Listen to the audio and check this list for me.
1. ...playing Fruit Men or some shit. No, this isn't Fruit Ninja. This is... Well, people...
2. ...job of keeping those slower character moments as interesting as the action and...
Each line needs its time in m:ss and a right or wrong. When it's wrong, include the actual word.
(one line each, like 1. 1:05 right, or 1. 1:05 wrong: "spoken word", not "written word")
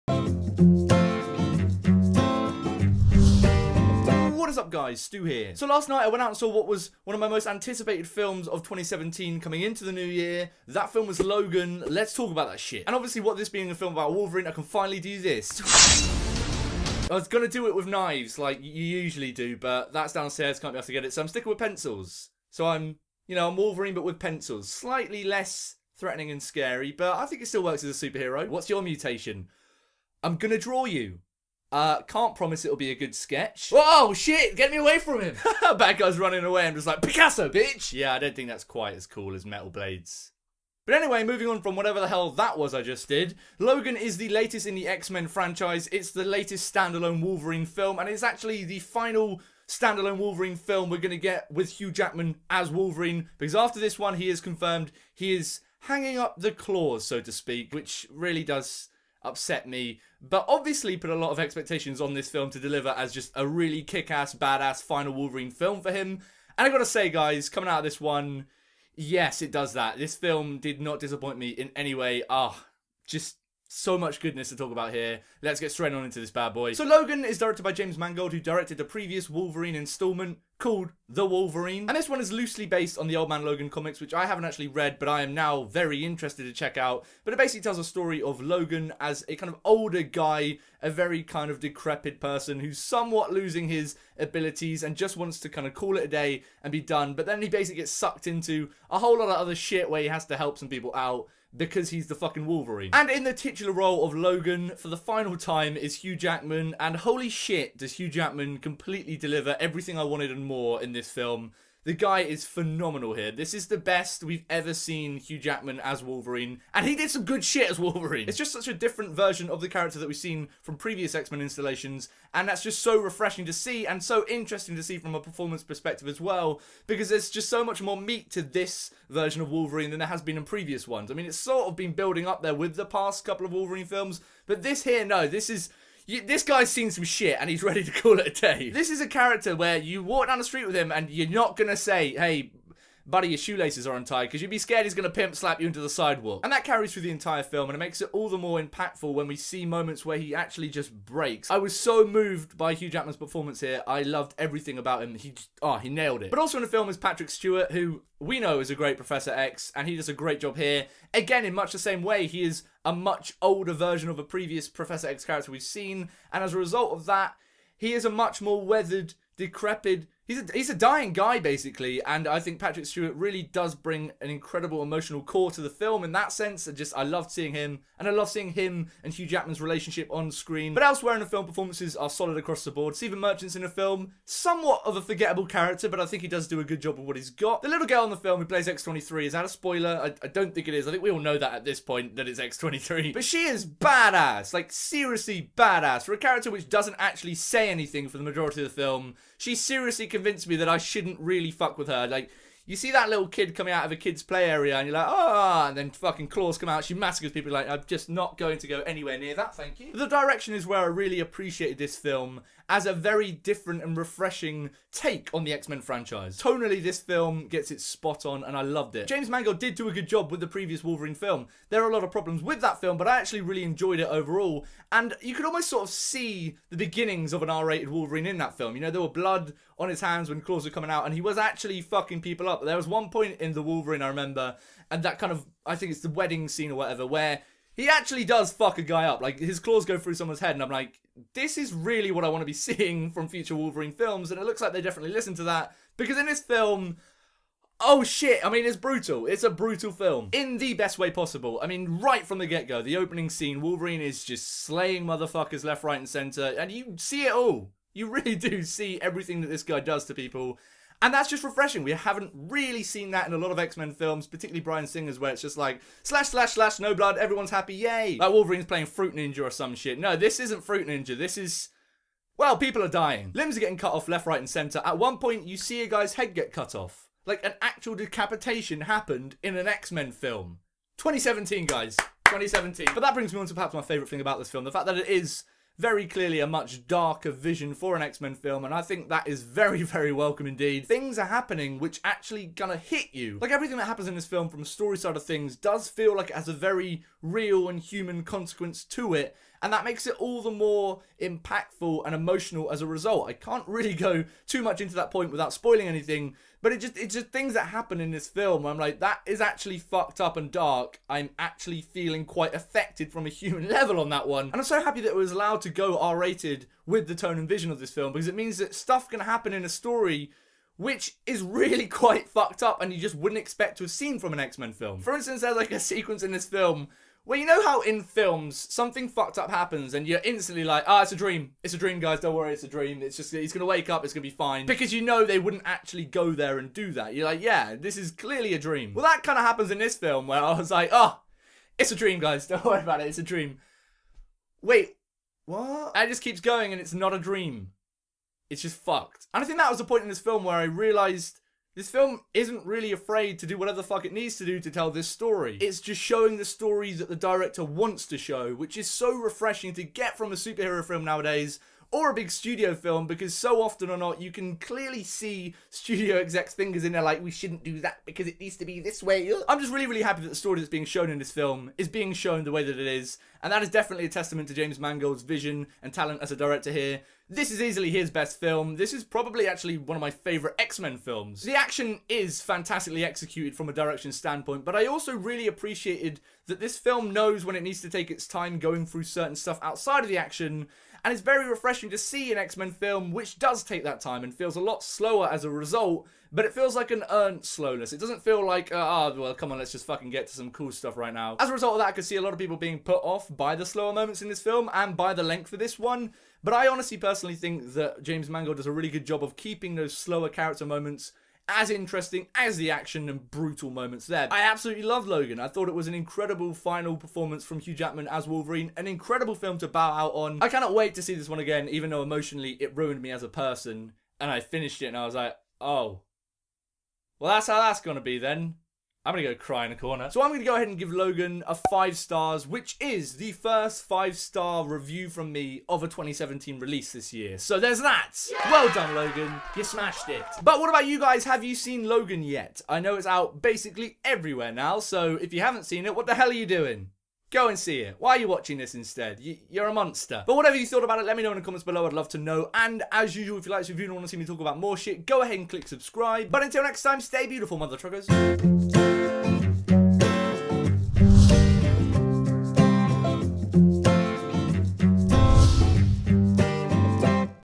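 1. 4:28 wrong: "Ninja", not "Men"
2. 6:49 right.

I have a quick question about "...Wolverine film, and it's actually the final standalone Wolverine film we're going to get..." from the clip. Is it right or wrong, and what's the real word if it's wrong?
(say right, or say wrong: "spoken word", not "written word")
right.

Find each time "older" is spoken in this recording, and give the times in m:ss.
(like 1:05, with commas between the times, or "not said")
1:29, 2:43.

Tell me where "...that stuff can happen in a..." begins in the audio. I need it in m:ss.
5:18.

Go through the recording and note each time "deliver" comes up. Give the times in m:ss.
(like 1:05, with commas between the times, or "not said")
1:02, 1:49.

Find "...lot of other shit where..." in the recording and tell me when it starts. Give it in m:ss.
1:39.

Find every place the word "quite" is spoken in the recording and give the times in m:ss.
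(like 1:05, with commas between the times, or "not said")
0:38, 5:12, 5:21.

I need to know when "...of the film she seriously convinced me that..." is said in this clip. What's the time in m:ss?
3:18.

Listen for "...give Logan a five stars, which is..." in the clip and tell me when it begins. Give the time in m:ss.
7:10.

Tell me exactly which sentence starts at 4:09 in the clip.
It's a brutal film in the best way possible.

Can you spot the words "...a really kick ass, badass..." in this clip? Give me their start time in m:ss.
1:03.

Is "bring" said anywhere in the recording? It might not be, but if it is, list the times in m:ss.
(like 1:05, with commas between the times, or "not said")
2:53, 4:43.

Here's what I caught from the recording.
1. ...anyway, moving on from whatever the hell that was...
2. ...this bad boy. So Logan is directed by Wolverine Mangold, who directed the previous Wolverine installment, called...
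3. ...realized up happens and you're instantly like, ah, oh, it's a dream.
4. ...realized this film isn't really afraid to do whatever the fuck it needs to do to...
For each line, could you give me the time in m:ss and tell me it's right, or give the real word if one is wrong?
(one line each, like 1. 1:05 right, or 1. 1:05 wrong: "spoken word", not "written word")
1. 0:40 right
2. 1:16 wrong: "James", not "Wolverine"
3. 5:29 wrong: "fucked", not "realized"
4. 5:50 right.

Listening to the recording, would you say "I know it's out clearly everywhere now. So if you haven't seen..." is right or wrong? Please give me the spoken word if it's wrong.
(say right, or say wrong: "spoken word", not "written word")
wrong: "basically", not "clearly".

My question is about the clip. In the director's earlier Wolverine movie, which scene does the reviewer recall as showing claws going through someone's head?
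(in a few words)
the wedding scene.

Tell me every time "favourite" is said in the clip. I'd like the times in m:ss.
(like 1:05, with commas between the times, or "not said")
4:43, 6:20.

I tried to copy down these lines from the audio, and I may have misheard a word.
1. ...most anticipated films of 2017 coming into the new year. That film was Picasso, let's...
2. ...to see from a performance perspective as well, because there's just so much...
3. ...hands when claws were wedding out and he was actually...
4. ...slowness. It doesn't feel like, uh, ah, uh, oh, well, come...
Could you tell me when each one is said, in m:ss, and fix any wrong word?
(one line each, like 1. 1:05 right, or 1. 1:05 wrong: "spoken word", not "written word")
1. 0:07 wrong: "Logan", not "Picasso"
2. 2:04 right
3. 3:49 wrong: "coming", not "wedding"
4. 6:37 right.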